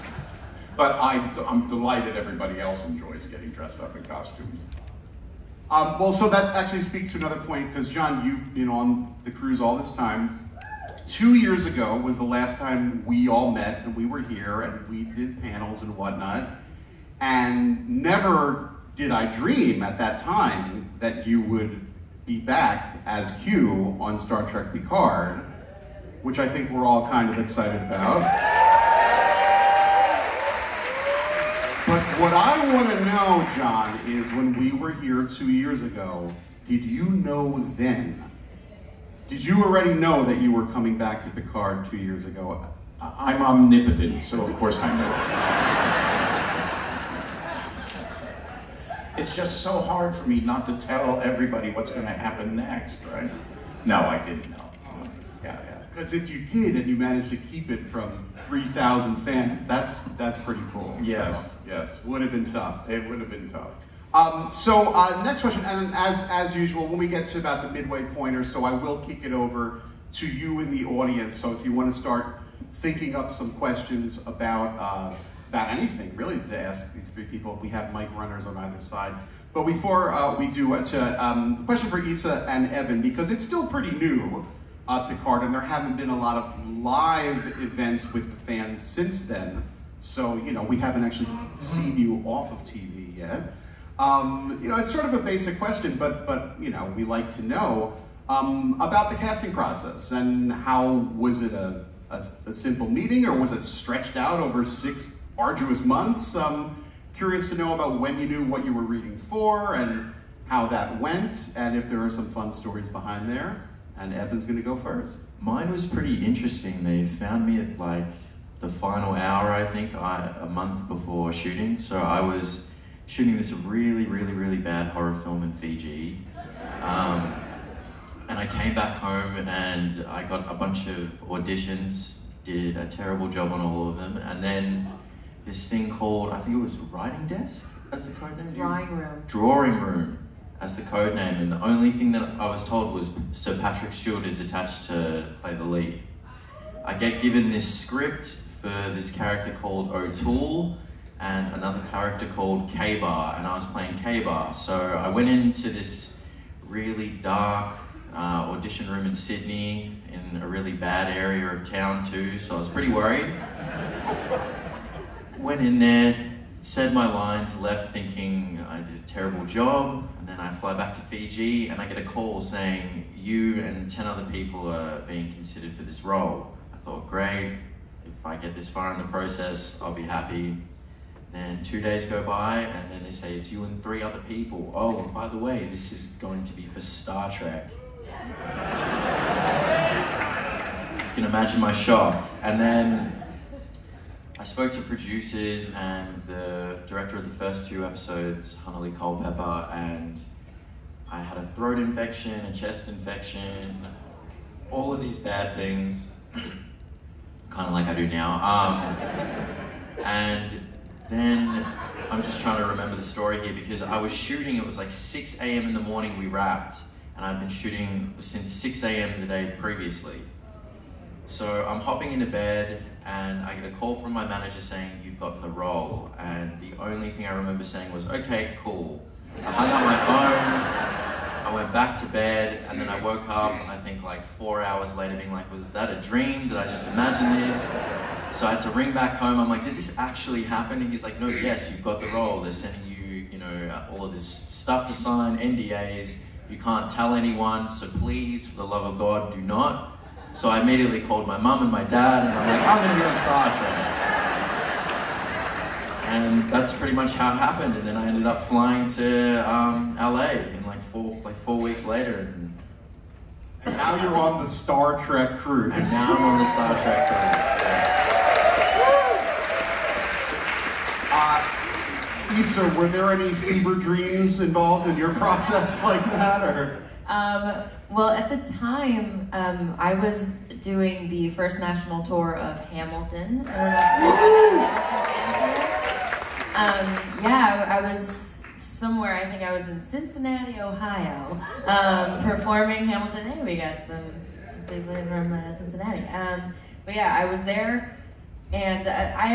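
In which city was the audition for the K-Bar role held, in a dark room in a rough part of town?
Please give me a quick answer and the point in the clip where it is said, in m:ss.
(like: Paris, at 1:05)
Sydney, at 2:39.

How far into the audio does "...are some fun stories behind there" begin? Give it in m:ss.
1:52.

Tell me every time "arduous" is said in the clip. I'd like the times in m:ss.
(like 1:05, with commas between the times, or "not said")
1:45.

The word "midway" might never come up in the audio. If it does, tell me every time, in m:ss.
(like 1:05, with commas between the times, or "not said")
1:07.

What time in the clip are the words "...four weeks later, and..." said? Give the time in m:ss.
4:21.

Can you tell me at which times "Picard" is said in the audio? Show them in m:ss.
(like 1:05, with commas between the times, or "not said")
0:24, 0:41, 1:25.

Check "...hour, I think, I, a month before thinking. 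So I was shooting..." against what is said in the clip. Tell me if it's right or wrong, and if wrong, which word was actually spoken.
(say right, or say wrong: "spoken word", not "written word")
wrong: "shooting", not "thinking".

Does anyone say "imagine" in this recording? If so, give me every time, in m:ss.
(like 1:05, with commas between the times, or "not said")
3:11, 3:56.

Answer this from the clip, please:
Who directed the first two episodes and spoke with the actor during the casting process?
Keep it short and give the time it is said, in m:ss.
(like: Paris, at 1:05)
Hanelle Culpepper, at 3:18.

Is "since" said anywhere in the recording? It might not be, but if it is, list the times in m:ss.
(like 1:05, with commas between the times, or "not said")
1:28, 3:38.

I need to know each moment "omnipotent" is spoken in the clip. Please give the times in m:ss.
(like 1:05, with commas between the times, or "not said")
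0:43.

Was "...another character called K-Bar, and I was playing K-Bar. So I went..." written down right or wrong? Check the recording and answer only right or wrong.
right.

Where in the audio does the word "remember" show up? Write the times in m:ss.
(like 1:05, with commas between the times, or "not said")
3:32, 3:47.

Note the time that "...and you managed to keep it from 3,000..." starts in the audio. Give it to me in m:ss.
0:56.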